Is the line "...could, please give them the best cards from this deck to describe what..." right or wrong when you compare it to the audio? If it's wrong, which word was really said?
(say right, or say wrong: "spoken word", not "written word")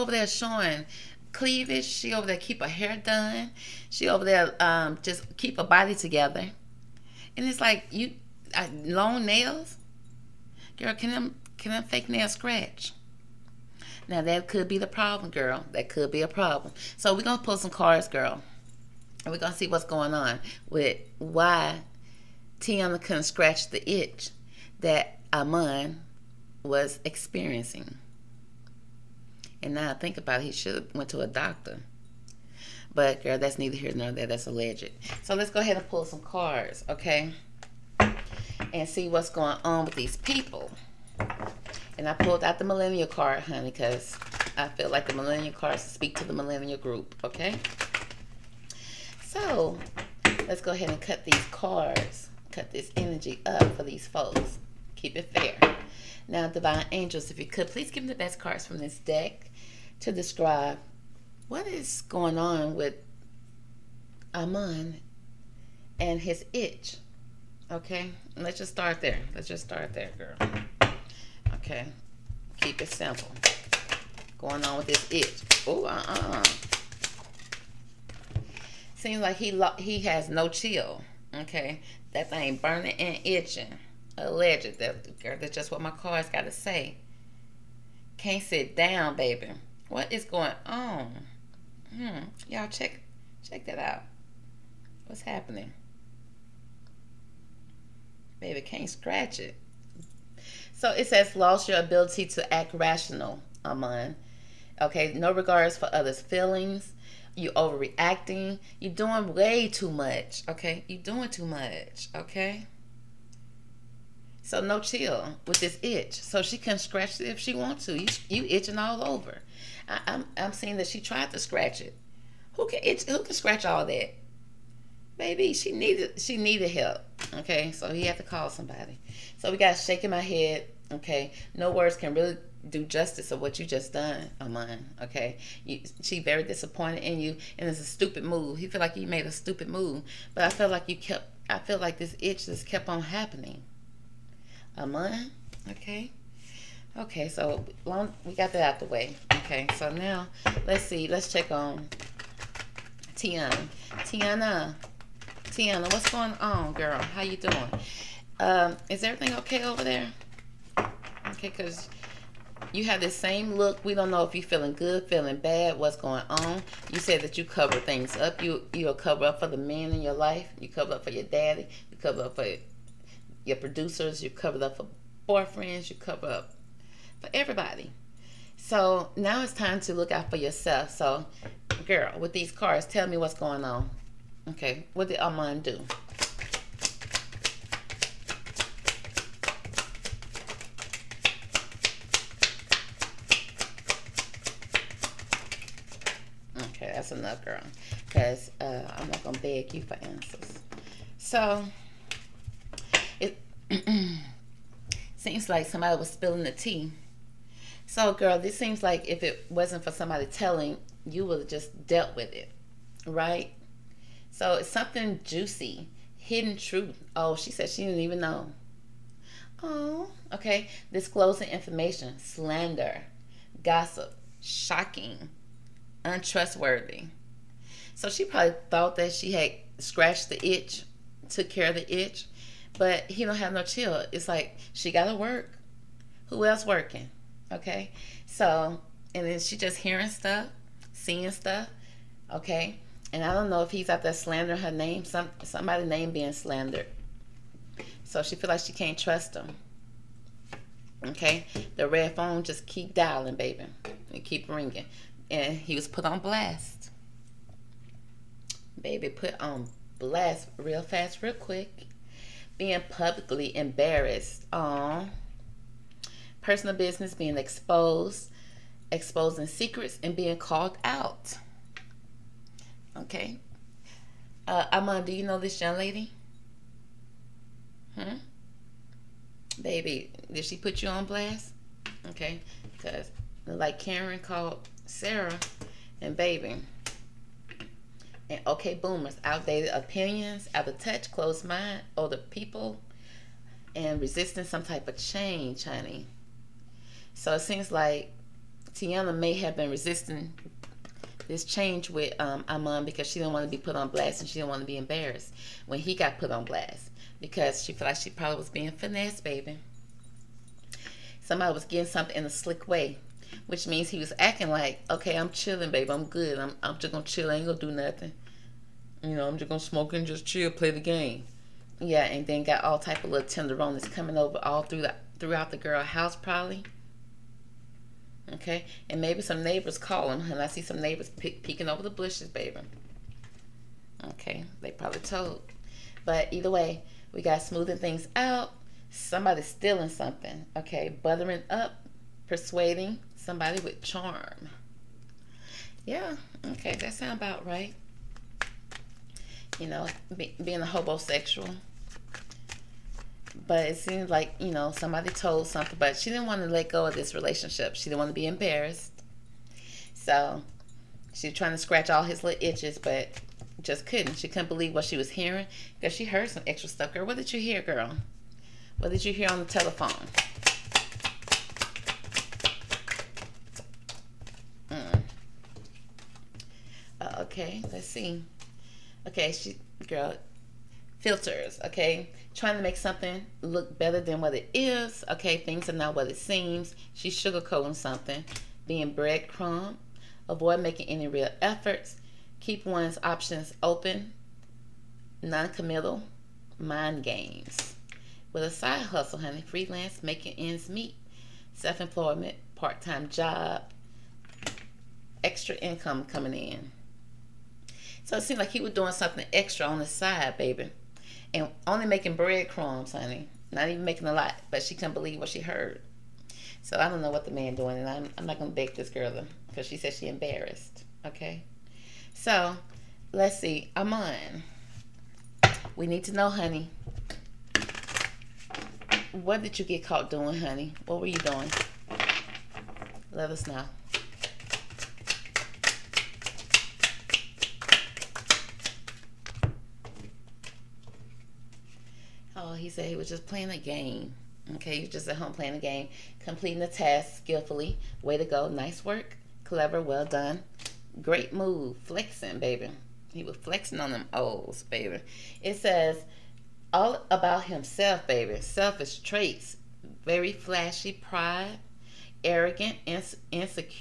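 right.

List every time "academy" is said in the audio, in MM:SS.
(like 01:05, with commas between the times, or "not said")
not said.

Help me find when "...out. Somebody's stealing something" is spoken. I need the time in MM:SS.
05:38.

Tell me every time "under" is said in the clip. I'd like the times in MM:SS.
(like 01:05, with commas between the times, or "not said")
not said.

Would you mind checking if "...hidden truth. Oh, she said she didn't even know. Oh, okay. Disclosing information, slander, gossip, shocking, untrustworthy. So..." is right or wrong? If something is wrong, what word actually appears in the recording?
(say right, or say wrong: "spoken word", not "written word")
right.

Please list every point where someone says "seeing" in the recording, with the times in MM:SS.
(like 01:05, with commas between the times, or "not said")
02:00, 04:00.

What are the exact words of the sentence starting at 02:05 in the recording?
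Baby, she needed she needed help.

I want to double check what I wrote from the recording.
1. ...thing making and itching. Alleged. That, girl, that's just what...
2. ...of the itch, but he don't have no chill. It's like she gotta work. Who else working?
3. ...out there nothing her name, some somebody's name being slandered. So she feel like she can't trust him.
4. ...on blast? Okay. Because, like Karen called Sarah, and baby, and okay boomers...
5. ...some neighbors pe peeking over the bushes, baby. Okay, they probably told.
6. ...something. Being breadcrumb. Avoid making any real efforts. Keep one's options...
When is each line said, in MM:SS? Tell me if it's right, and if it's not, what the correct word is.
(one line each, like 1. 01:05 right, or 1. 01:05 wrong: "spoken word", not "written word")
1. 01:22 wrong: "burning", not "making"
2. 03:51 right
3. 04:03 wrong: "slandering", not "nothing"
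4. 04:40 right
5. 05:30 right
6. 06:27 right.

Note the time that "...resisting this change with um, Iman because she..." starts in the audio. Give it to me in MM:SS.
04:59.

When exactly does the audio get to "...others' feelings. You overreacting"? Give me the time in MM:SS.
01:45.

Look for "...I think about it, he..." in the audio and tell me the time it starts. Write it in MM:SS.
00:29.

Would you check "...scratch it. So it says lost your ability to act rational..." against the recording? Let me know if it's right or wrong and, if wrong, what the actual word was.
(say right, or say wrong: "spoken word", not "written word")
right.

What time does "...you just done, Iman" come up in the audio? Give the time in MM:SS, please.
02:13.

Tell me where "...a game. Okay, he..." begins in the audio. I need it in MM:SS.
07:23.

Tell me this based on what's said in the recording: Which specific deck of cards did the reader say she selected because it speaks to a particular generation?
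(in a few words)
The millennial card.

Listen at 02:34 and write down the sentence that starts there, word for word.
Teyana, Teyana, what's going on, girl?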